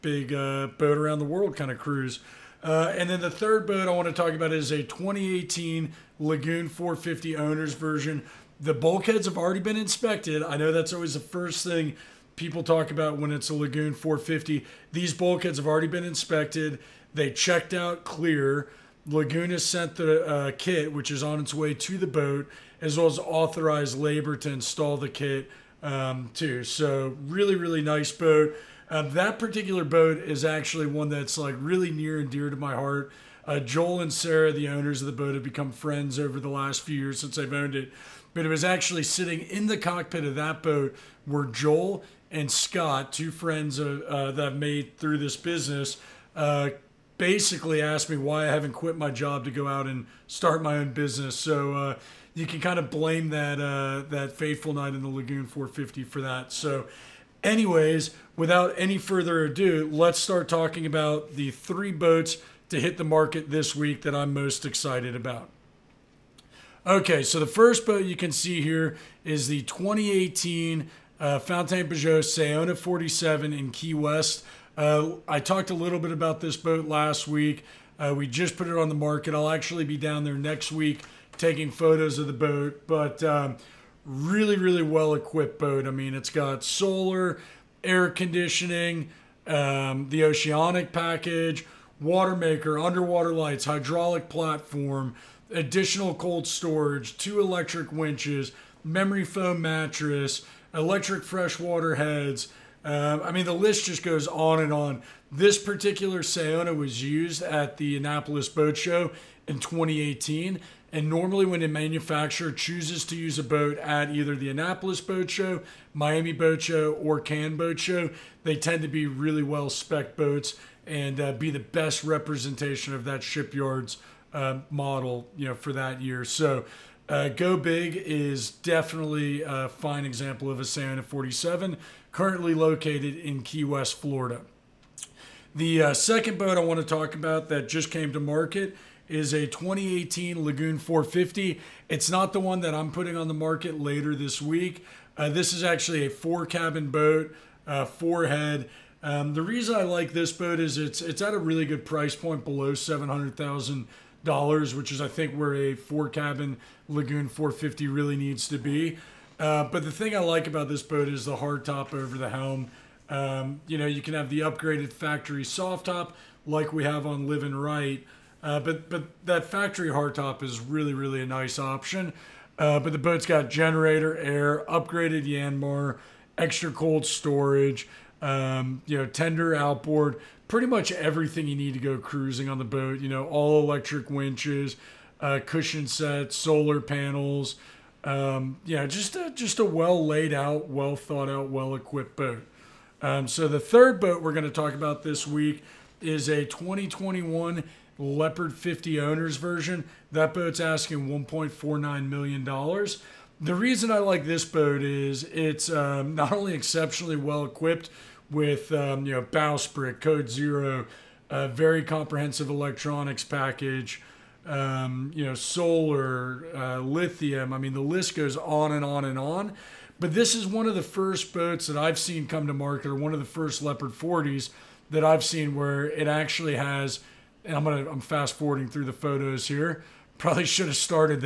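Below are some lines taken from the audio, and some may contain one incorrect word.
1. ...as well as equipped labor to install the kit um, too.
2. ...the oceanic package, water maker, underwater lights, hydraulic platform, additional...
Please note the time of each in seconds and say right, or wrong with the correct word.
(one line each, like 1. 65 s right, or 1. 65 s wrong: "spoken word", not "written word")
1. 22 s wrong: "authorized", not "equipped"
2. 90 s right.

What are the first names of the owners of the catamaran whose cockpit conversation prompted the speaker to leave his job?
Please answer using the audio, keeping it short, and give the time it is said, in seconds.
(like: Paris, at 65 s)
Joel and Sarah, at 33 s.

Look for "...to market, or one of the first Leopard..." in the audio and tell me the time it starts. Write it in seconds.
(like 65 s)
222 s.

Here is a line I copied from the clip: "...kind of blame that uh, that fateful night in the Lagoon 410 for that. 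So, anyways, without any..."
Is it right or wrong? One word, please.
wrong.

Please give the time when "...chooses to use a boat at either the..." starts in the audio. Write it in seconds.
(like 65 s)
112 s.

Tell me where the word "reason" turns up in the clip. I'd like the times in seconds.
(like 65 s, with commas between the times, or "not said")
149 s, 203 s.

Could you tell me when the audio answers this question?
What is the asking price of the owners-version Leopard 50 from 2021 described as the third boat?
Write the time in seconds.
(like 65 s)
201 s.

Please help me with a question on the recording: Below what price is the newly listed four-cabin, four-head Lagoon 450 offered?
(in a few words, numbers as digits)
$700,000.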